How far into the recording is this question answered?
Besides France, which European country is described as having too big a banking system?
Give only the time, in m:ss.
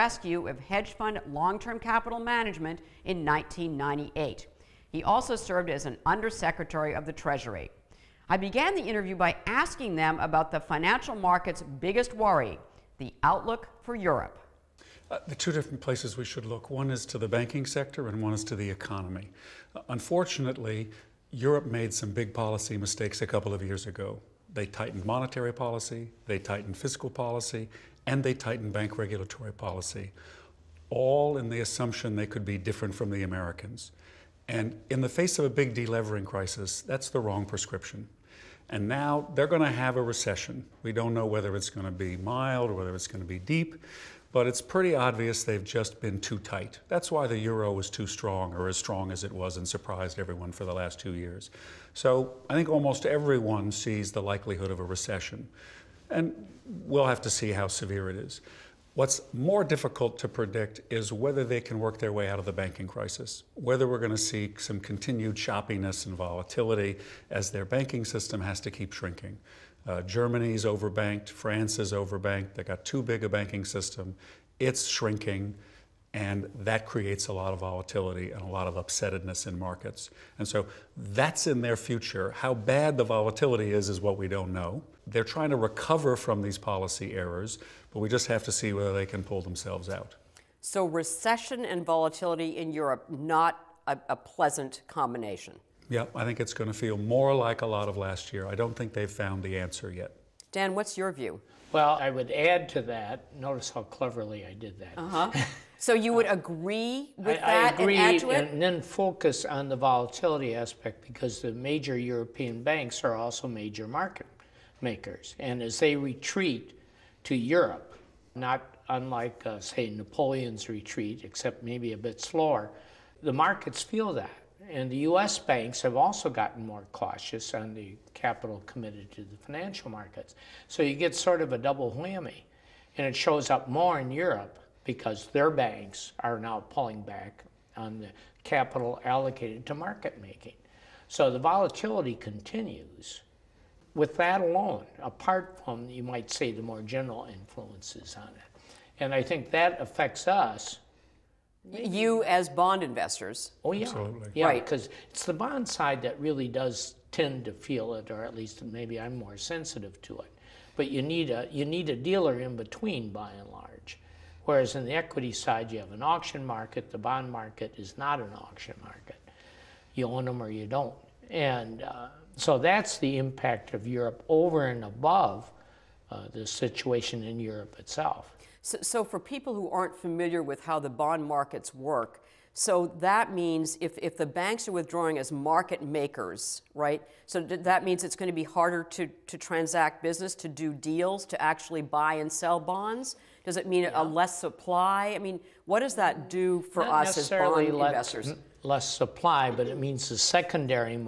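1:10.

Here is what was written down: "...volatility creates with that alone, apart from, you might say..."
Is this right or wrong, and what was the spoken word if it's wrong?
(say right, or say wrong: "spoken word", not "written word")
wrong: "continues", not "creates".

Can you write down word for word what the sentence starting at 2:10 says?
So you get sort of a double whammy.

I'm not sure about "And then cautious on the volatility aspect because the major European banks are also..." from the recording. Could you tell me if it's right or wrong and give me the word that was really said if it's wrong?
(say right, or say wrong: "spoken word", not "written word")
wrong: "focus", not "cautious".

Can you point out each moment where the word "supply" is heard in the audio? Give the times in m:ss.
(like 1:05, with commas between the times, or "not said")
3:14, 3:18.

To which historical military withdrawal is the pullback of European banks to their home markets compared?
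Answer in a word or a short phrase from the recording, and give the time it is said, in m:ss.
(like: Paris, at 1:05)
Napoleon's retreat, at 1:59.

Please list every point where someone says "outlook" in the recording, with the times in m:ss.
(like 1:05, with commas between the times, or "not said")
0:13.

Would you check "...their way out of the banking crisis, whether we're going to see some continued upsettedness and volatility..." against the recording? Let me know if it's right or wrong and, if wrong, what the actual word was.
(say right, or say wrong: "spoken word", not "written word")
wrong: "choppiness", not "upsettedness".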